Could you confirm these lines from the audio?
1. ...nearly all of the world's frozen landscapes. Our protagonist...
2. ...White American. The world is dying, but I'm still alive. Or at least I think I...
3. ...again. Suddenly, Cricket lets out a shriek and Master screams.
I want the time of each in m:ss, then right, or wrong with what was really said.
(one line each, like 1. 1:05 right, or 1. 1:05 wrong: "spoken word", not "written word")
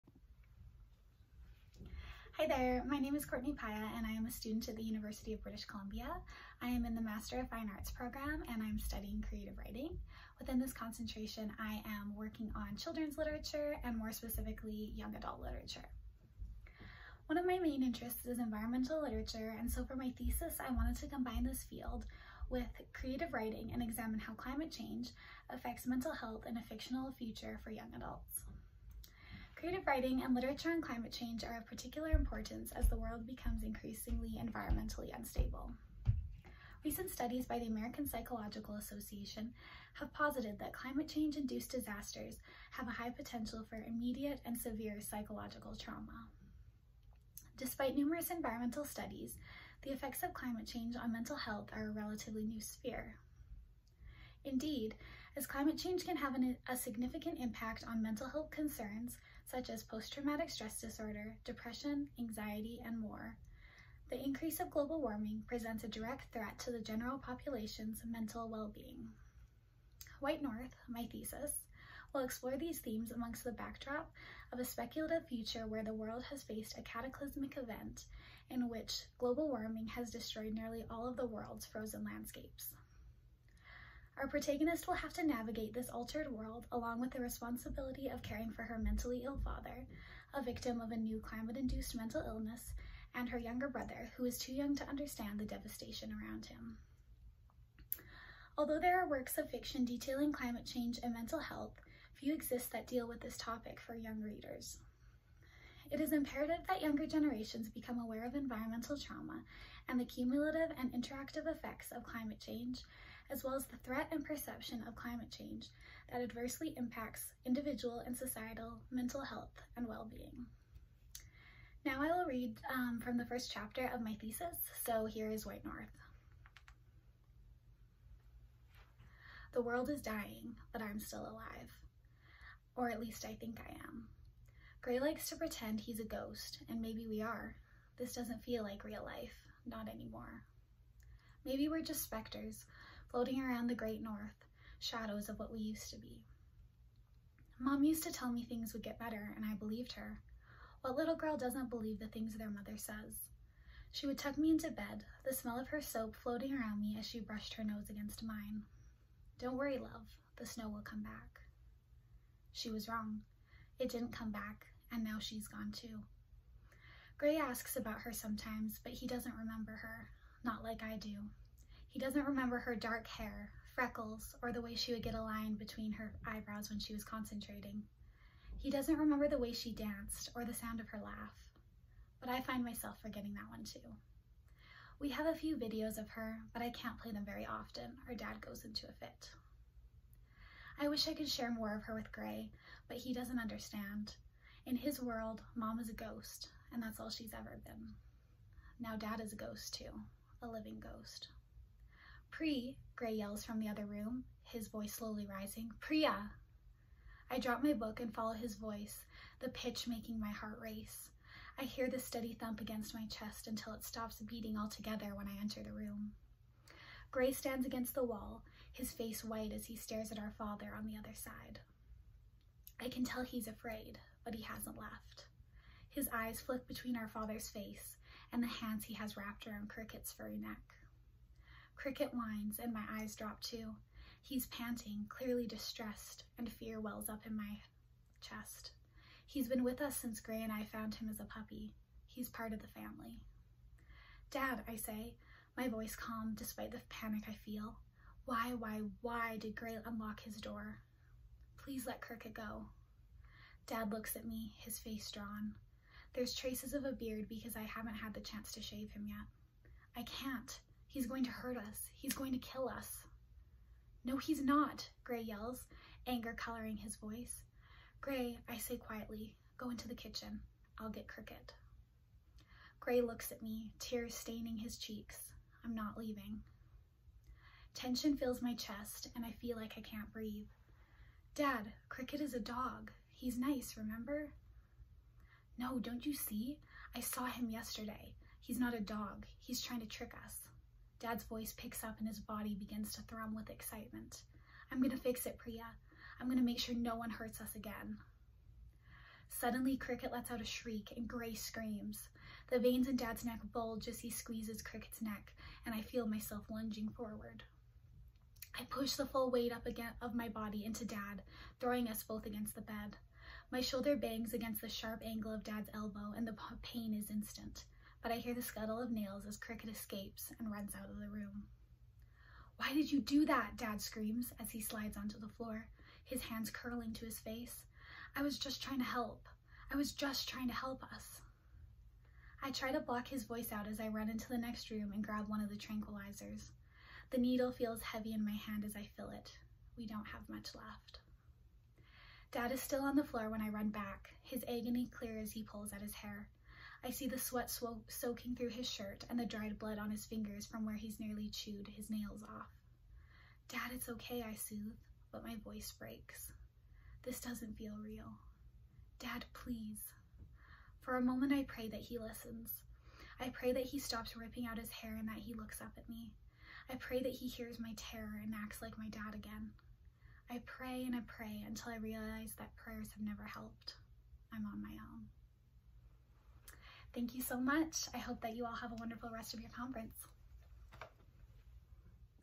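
1. 1:20 right
2. 2:05 wrong: "North", not "American"
3. 4:57 wrong: "Gray", not "Master".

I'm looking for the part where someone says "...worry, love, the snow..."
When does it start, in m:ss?
2:39.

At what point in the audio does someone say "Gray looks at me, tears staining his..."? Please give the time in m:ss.
4:32.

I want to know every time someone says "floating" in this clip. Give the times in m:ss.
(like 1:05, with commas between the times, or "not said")
2:23, 2:36.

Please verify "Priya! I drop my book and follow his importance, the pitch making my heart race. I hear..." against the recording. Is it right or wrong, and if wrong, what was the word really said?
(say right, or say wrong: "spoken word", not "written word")
wrong: "voice", not "importance".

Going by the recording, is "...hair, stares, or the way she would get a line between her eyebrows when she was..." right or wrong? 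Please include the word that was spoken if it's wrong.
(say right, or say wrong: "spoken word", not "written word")
wrong: "freckles", not "stares".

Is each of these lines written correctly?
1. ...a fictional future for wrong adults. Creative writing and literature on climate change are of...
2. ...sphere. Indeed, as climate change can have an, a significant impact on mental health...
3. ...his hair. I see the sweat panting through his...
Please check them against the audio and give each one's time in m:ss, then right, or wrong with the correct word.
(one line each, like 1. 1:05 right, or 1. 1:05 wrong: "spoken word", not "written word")
1. 0:26 wrong: "young", not "wrong"
2. 0:52 right
3. 5:45 wrong: "soaking", not "panting".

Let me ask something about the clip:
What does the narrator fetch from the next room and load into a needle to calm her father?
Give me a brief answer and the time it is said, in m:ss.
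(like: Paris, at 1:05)
tranquilizers, at 5:35.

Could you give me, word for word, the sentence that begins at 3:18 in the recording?
Now dad is a ghost too, a living ghost.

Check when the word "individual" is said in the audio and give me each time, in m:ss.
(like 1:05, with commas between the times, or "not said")
1:57.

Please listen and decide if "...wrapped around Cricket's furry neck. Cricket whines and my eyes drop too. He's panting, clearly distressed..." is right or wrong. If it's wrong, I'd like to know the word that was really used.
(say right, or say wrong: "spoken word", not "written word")
right.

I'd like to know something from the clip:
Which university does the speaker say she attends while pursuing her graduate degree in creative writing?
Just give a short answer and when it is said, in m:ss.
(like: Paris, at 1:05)
University of British Columbia, at 0:04.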